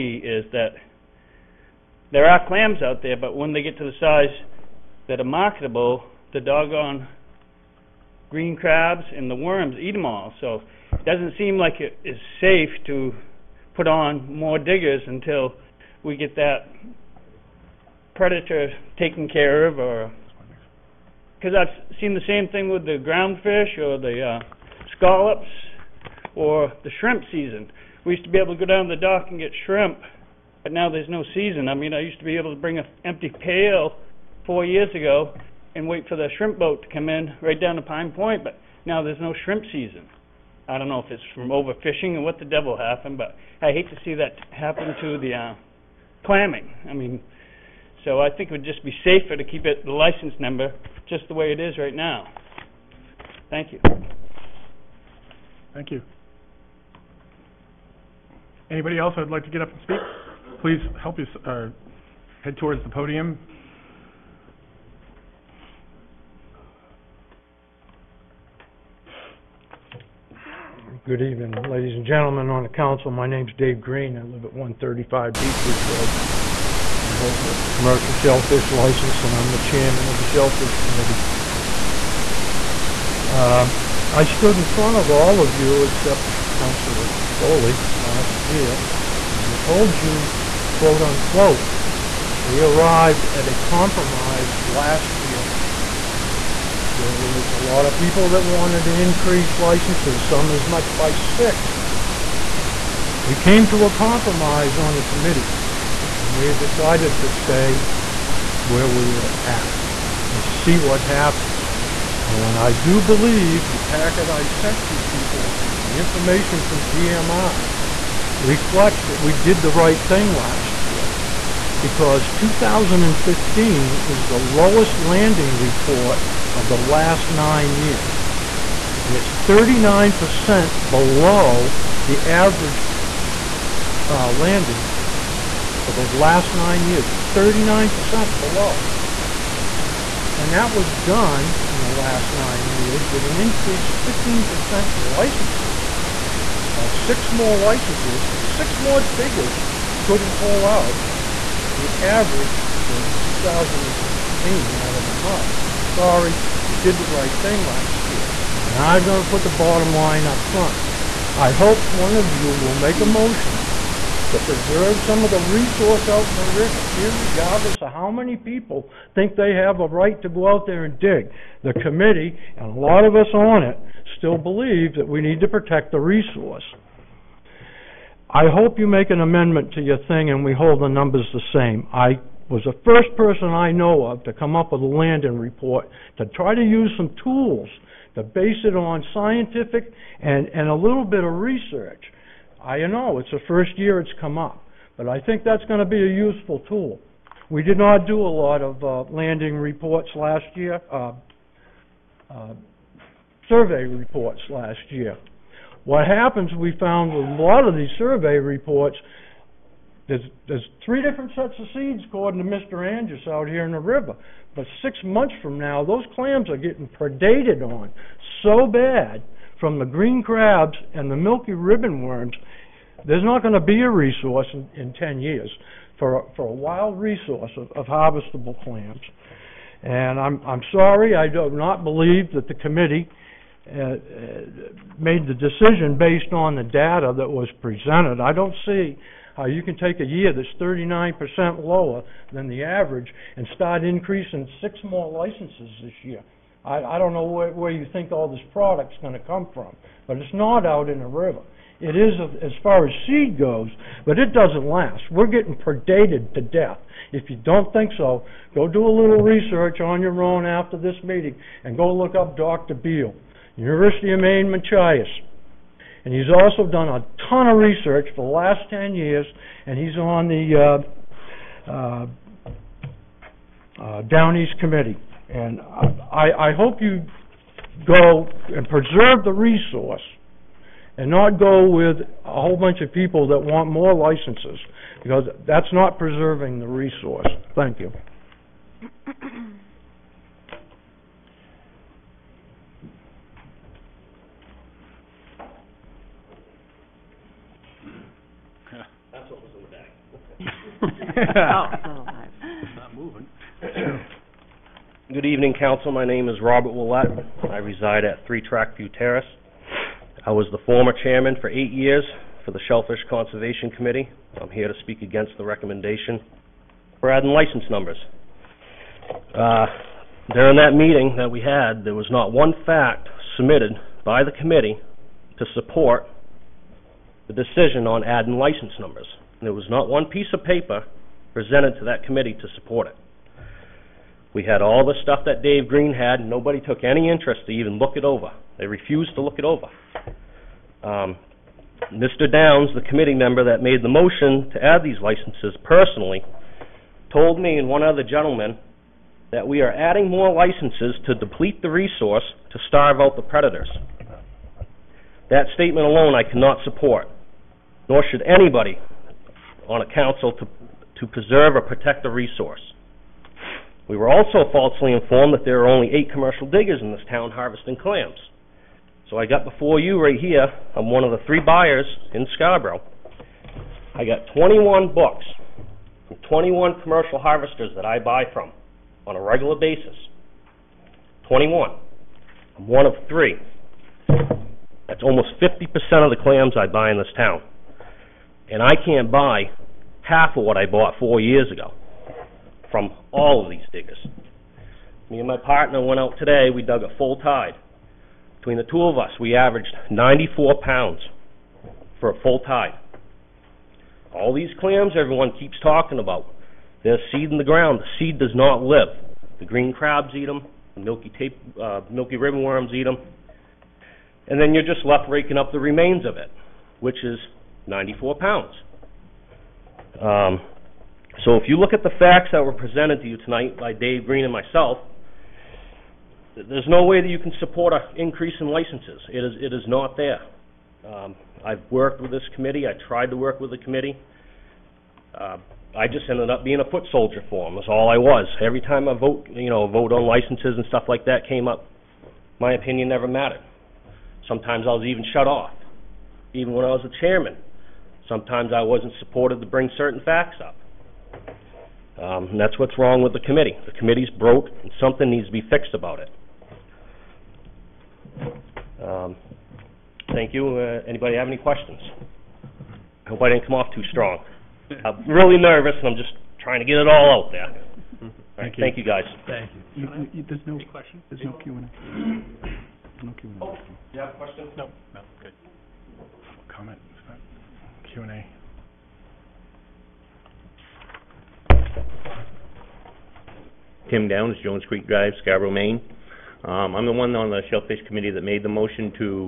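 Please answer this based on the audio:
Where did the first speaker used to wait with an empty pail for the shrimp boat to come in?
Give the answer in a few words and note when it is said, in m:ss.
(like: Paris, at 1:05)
Pine Point, at 0:37.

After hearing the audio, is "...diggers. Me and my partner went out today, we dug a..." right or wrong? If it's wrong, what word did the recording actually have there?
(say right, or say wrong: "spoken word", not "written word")
right.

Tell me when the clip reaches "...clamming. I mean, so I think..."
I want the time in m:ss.
0:46.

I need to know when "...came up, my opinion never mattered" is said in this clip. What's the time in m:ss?
7:21.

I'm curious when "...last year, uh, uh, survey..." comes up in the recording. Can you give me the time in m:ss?
3:20.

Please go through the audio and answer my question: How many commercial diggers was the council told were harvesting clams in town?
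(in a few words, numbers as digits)
8.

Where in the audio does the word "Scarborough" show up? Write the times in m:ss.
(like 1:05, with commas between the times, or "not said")
6:12, 8:05.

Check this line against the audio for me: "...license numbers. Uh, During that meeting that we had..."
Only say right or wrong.
right.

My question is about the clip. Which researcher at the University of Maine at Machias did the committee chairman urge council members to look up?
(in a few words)
Dr. Beal.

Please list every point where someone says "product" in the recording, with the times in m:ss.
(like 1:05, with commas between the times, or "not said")
4:08.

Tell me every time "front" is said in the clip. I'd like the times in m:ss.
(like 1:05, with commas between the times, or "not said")
1:24, 2:40.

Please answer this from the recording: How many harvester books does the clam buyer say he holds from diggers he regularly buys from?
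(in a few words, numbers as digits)
21.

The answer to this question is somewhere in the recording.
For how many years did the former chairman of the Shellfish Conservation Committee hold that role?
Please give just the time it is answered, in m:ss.
5:11.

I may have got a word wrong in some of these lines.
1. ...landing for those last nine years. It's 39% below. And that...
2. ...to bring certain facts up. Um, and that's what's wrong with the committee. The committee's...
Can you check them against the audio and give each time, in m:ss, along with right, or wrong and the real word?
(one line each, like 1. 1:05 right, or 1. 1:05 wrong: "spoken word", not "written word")
1. 2:14 right
2. 7:29 right.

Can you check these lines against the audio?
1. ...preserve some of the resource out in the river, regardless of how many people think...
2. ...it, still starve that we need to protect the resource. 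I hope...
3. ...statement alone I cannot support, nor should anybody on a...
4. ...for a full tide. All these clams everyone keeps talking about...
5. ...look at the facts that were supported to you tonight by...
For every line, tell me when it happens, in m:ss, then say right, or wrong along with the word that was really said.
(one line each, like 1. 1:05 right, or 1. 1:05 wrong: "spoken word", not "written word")
1. 2:44 right
2. 2:53 wrong: "believe", not "starve"
3. 5:55 right
4. 6:41 right
5. 7:01 wrong: "presented", not "supported".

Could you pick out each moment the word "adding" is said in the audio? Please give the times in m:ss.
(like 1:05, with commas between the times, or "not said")
5:17, 5:28, 5:49.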